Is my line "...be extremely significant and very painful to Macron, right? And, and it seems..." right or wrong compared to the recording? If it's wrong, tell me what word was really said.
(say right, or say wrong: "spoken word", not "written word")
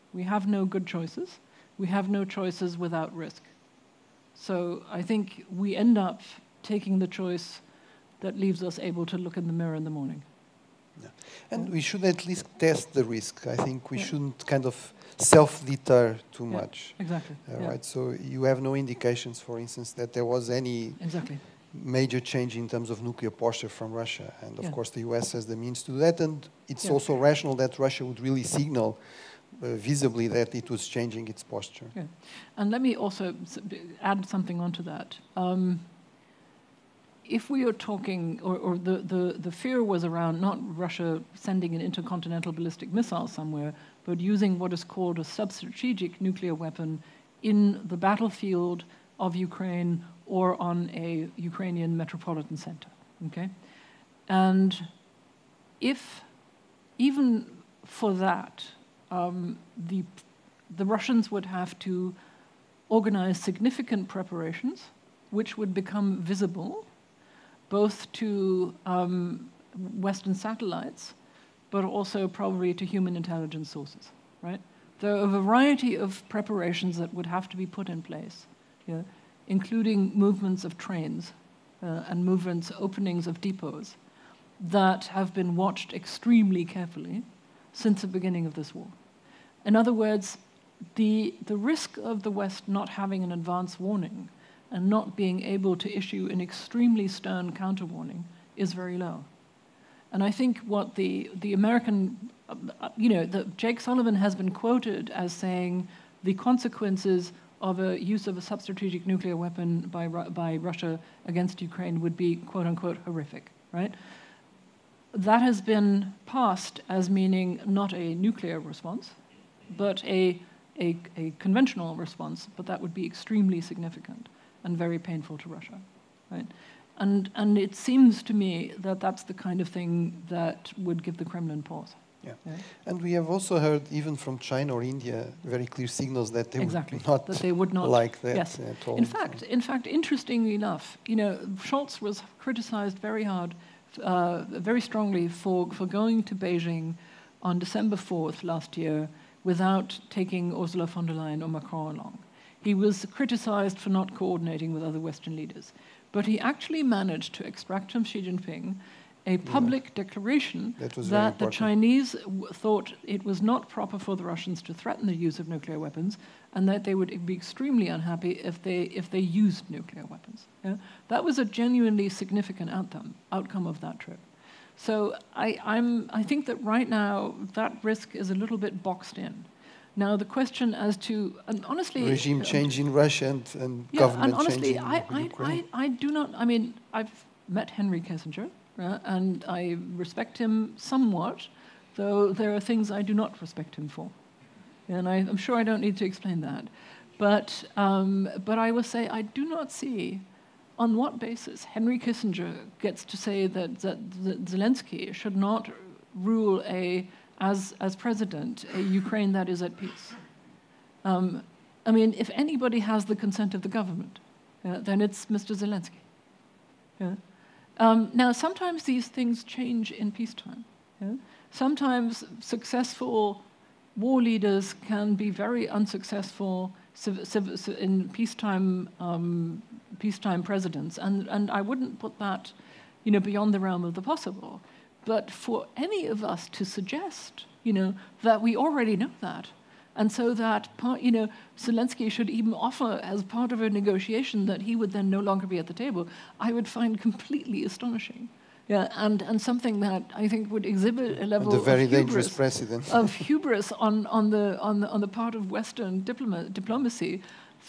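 wrong: "Russia", not "Macron".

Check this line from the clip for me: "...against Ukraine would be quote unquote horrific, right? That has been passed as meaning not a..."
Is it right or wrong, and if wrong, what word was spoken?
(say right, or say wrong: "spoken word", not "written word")
right.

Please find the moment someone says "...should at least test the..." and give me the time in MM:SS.
00:11.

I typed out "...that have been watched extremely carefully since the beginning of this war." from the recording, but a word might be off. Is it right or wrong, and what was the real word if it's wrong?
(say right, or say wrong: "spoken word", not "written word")
right.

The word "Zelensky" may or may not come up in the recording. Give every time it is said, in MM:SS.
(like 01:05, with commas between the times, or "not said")
03:24, 03:35, 04:01.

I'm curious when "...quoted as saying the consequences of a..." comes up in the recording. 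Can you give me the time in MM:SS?
01:44.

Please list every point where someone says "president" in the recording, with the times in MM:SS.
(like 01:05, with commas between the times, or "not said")
03:27, 03:50, 04:12.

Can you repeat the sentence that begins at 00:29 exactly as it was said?
Uh, visibly that it was changing its posture.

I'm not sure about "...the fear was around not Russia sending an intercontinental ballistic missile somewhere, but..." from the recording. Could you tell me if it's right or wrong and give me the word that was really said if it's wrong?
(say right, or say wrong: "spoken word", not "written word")
right.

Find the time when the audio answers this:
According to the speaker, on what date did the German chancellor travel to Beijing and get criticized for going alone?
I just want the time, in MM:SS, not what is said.
02:27.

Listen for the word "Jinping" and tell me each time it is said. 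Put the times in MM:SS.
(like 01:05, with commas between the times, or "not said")
02:38.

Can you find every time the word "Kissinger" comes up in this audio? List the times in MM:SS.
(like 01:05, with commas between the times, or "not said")
03:07, 03:21.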